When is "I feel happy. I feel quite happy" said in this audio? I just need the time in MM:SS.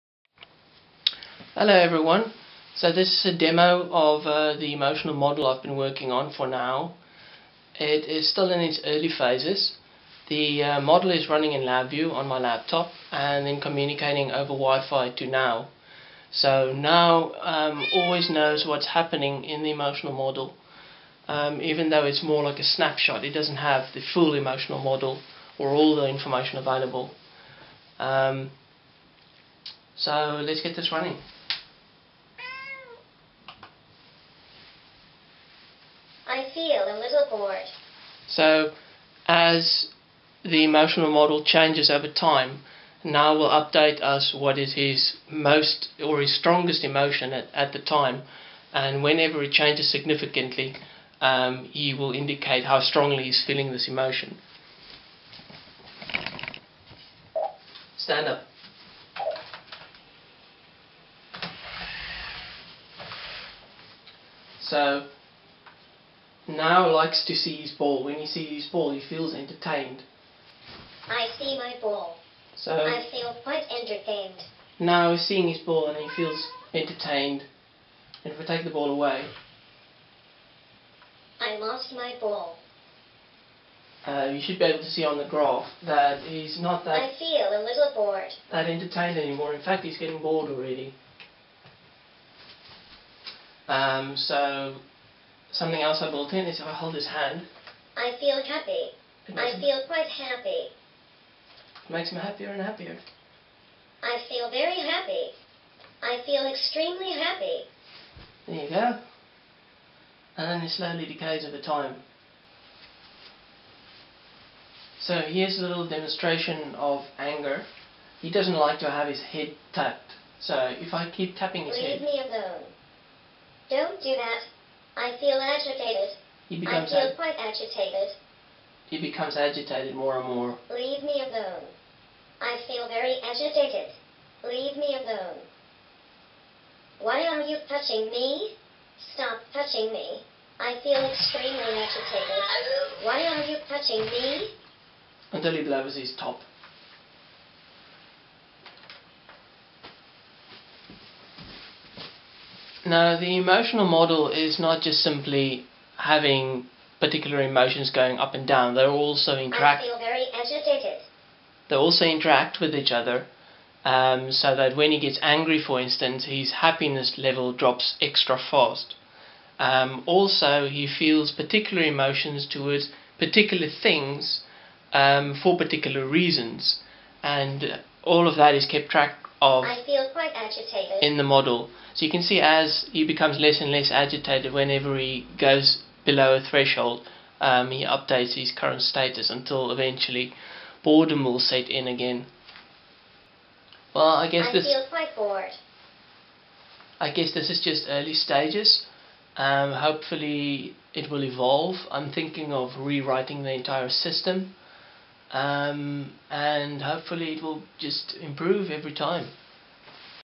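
01:37.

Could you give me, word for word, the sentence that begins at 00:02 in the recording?
So this is a demo of uh, the emotional model I've been working on for NAO.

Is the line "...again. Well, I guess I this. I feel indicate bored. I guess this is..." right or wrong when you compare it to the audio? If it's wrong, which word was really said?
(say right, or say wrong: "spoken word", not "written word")
wrong: "quite", not "indicate".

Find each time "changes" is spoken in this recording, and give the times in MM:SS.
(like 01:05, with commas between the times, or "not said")
00:41, 00:49.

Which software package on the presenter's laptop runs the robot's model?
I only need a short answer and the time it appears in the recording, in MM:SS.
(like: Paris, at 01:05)
LabVIEW, at 00:11.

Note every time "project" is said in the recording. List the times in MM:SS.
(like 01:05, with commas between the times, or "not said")
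not said.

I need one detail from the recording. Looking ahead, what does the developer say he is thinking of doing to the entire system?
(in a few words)
rewriting.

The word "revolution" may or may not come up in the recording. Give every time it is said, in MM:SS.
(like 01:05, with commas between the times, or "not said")
not said.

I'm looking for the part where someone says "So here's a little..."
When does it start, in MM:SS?
01:55.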